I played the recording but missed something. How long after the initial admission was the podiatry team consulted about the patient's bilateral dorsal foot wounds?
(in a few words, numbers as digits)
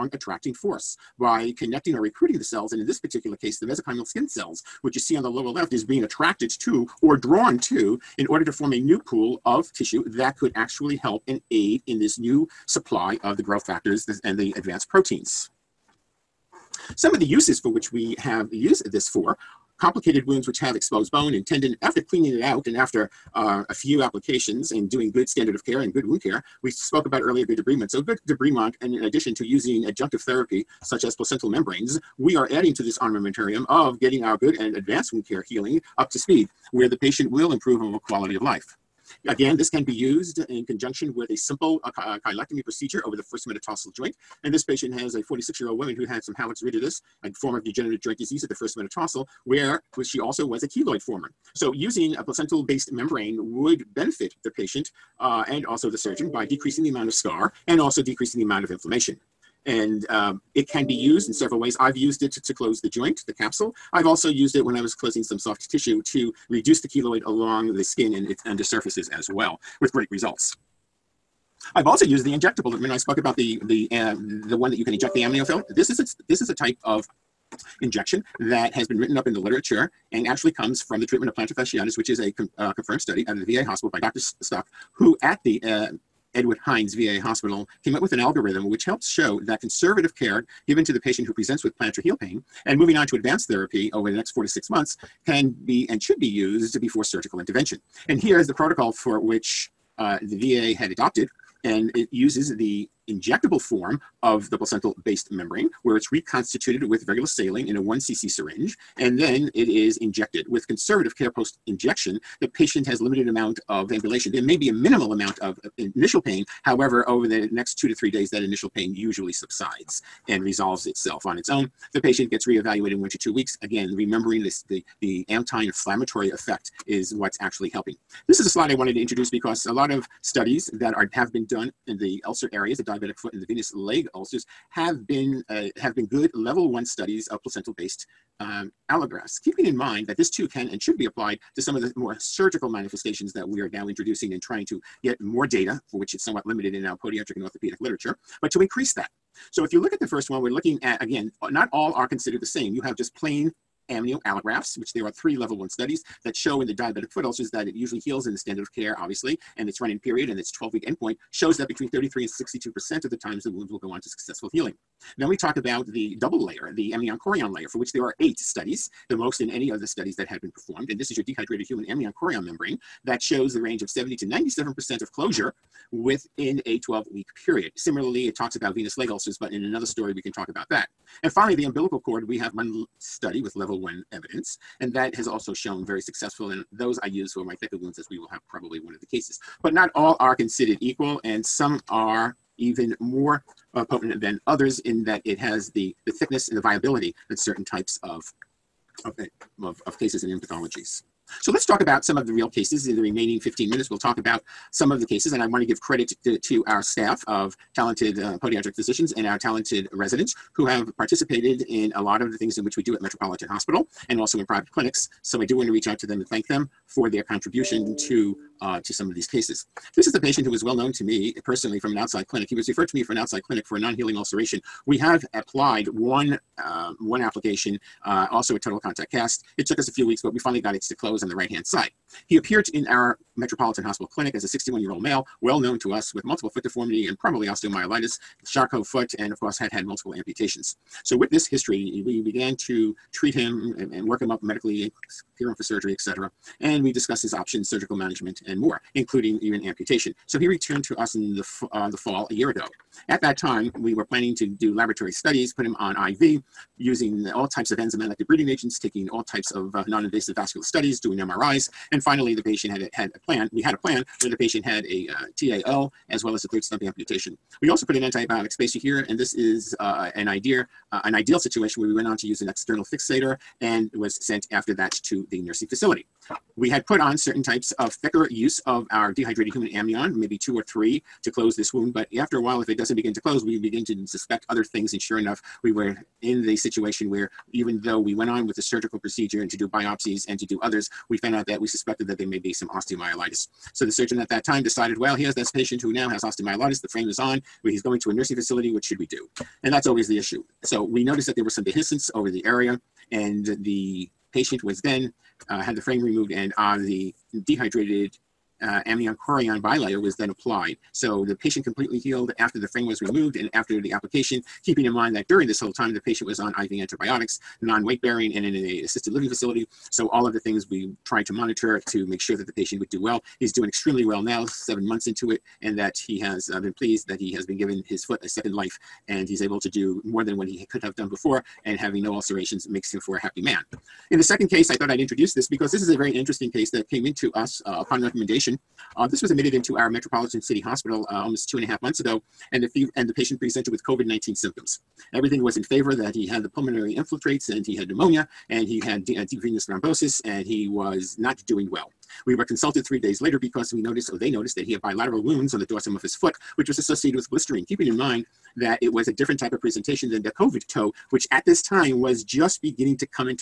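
3 days.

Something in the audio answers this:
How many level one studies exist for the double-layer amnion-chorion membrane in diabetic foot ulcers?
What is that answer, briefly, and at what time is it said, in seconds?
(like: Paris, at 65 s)
8, at 168 s.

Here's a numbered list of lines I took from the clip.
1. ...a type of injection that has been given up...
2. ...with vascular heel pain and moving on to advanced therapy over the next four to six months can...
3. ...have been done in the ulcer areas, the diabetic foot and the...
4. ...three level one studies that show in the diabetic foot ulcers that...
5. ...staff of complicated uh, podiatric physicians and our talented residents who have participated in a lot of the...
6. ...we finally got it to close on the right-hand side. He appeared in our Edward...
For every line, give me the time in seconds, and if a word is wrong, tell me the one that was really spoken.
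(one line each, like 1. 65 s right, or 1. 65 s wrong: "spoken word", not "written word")
1. 76 s wrong: "written", not "given"
2. 91 s wrong: "plantar", not "vascular"
3. 131 s right
4. 155 s right
5. 206 s wrong: "talented", not "complicated"
6. 230 s wrong: "Metropolitan", not "Edward".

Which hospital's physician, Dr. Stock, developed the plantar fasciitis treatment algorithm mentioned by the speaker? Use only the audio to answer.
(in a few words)
Edward Hines VA Hospital.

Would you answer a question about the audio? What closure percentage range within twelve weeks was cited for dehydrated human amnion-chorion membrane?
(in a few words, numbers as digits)
70 to 97%.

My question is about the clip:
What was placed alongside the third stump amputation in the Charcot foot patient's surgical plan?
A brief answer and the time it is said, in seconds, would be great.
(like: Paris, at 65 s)
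Antibiotic spacer, at 268 s.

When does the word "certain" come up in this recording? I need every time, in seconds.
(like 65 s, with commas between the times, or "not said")
197 s, 277 s.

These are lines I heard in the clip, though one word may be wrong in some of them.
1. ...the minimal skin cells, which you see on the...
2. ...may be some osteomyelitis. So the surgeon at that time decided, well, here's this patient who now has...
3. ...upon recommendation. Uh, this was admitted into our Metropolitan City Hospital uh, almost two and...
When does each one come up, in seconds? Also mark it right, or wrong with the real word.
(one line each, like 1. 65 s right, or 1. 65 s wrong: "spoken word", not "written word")
1. 3 s wrong: "mesenchymal", not "minimal"
2. 292 s right
3. 337 s right.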